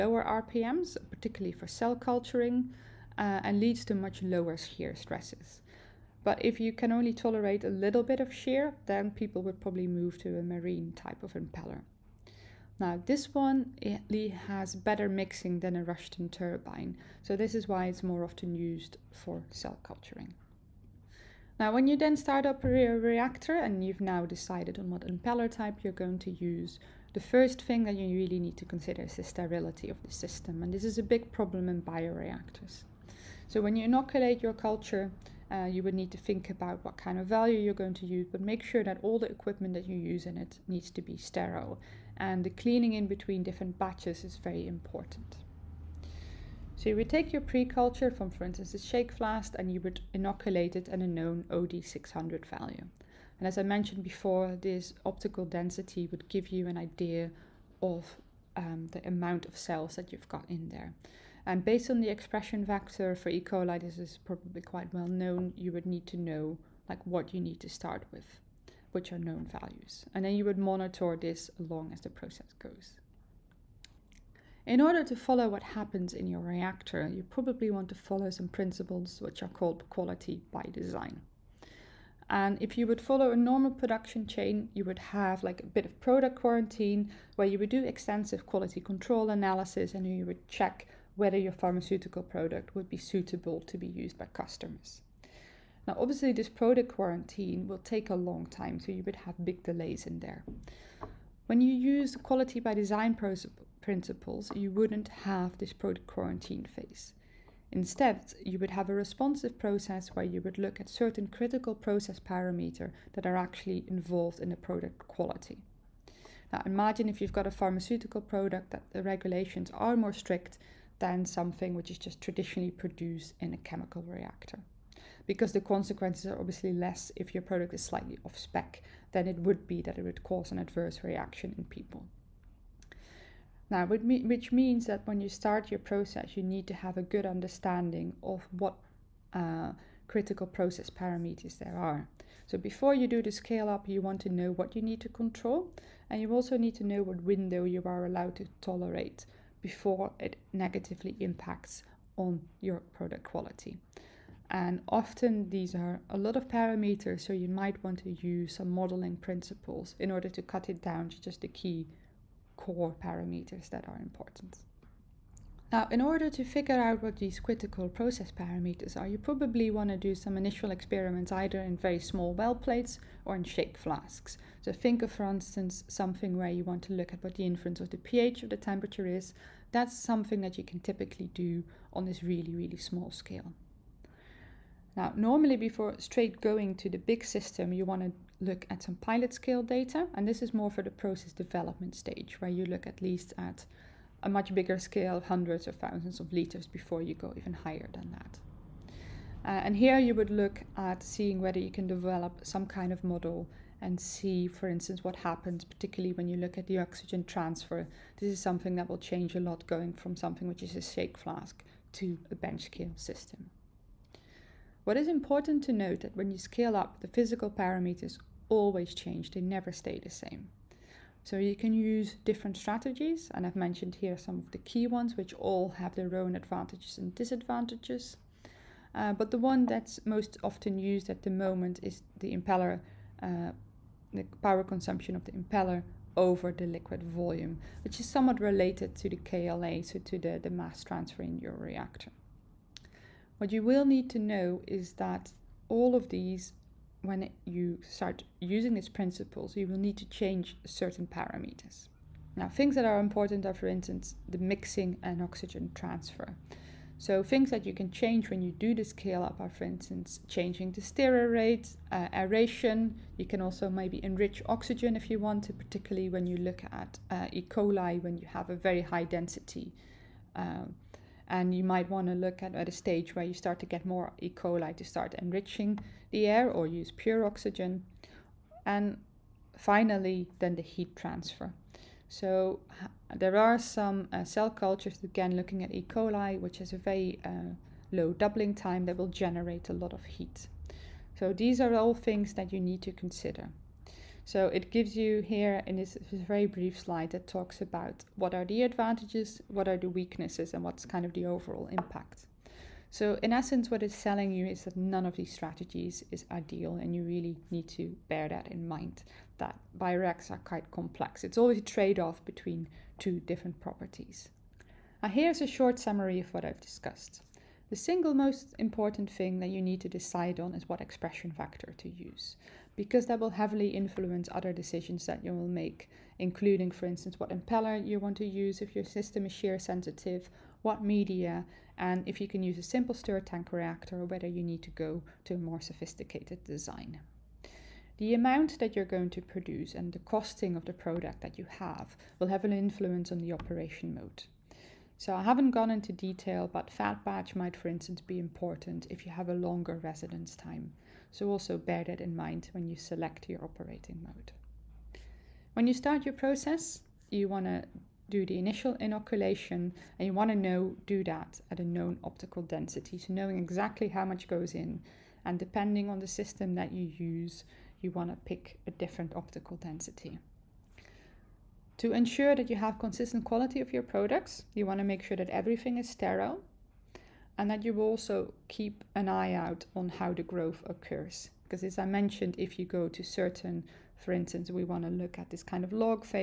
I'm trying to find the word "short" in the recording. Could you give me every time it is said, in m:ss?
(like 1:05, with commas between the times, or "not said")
5:15.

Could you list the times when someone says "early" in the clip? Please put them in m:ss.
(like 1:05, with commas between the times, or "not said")
not said.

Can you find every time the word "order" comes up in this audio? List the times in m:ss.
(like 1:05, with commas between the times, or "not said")
1:14, 2:40, 2:46.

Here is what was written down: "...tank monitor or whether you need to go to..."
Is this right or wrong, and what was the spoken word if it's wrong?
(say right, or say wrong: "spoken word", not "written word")
wrong: "reactor", not "monitor".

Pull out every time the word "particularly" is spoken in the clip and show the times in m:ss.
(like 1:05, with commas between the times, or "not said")
0:01, 3:25, 4:25.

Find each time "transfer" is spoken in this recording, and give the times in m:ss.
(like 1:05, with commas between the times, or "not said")
3:27, 4:00, 4:15, 4:40.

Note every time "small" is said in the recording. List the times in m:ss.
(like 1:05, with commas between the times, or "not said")
2:51, 3:02.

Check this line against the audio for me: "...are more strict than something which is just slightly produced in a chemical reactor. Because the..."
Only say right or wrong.
wrong.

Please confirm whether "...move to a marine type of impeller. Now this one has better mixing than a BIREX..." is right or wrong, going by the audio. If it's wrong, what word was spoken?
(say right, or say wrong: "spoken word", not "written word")
wrong: "Rushton", not "BIREX".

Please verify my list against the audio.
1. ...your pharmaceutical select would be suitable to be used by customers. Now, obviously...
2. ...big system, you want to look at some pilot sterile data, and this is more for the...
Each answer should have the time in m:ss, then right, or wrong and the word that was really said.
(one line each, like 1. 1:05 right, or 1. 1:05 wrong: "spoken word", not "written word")
1. 1:31 wrong: "product", not "select"
2. 3:06 wrong: "scale", not "sterile".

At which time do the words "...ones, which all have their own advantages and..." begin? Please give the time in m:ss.
3:44.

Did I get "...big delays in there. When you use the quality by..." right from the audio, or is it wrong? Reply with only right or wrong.
right.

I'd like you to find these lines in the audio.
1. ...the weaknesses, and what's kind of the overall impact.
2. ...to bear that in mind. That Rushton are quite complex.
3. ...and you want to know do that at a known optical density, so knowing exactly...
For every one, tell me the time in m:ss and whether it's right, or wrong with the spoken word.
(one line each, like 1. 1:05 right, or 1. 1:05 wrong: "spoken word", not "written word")
1. 4:59 right
2. 5:07 wrong: "BIREX", not "Rushton"
3. 5:59 right.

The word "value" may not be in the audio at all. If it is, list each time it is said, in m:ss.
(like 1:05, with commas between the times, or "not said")
0:37, 0:52, 1:09.